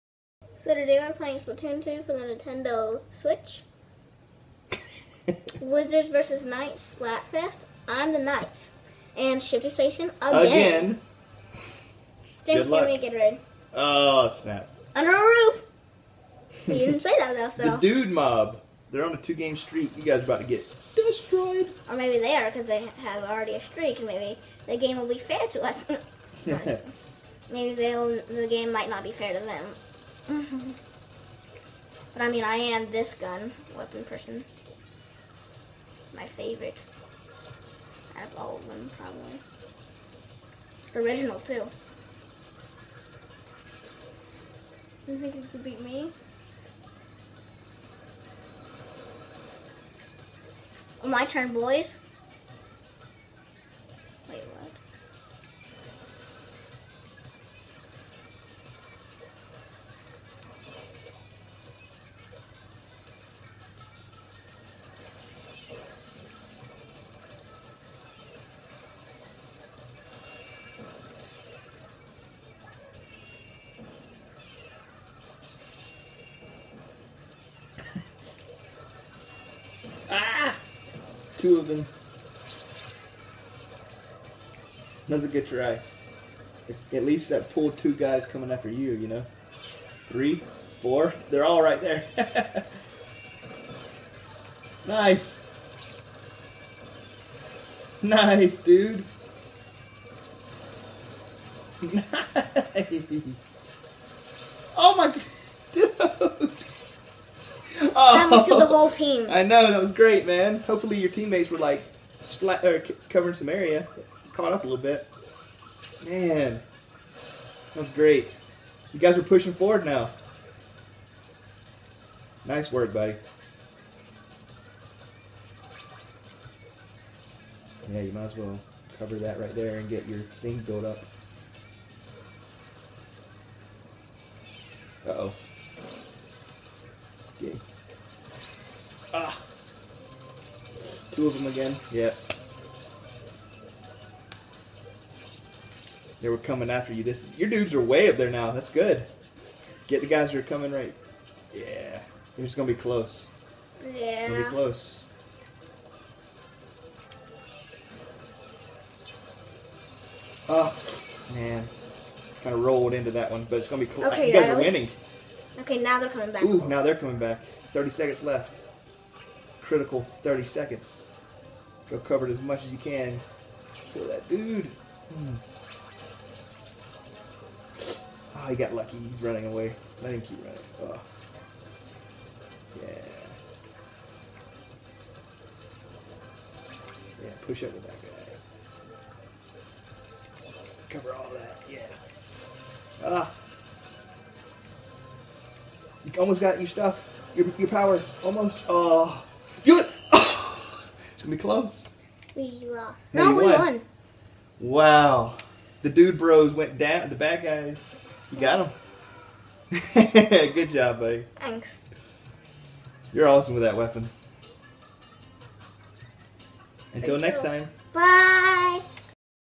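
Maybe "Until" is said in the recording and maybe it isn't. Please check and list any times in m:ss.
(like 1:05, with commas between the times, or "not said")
3:36.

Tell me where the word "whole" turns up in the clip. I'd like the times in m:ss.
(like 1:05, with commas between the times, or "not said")
1:48.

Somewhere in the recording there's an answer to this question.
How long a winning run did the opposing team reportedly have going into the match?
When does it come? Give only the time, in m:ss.
0:19.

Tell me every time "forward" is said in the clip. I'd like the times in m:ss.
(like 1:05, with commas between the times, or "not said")
1:59.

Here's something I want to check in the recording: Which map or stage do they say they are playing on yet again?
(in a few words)
Shifty Station.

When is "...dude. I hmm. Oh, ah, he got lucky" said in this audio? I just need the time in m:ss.
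2:54.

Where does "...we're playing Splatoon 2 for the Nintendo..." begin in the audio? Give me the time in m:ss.
0:01.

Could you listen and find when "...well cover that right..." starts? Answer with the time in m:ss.
2:08.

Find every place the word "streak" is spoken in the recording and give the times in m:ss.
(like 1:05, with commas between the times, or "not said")
0:19, 0:23.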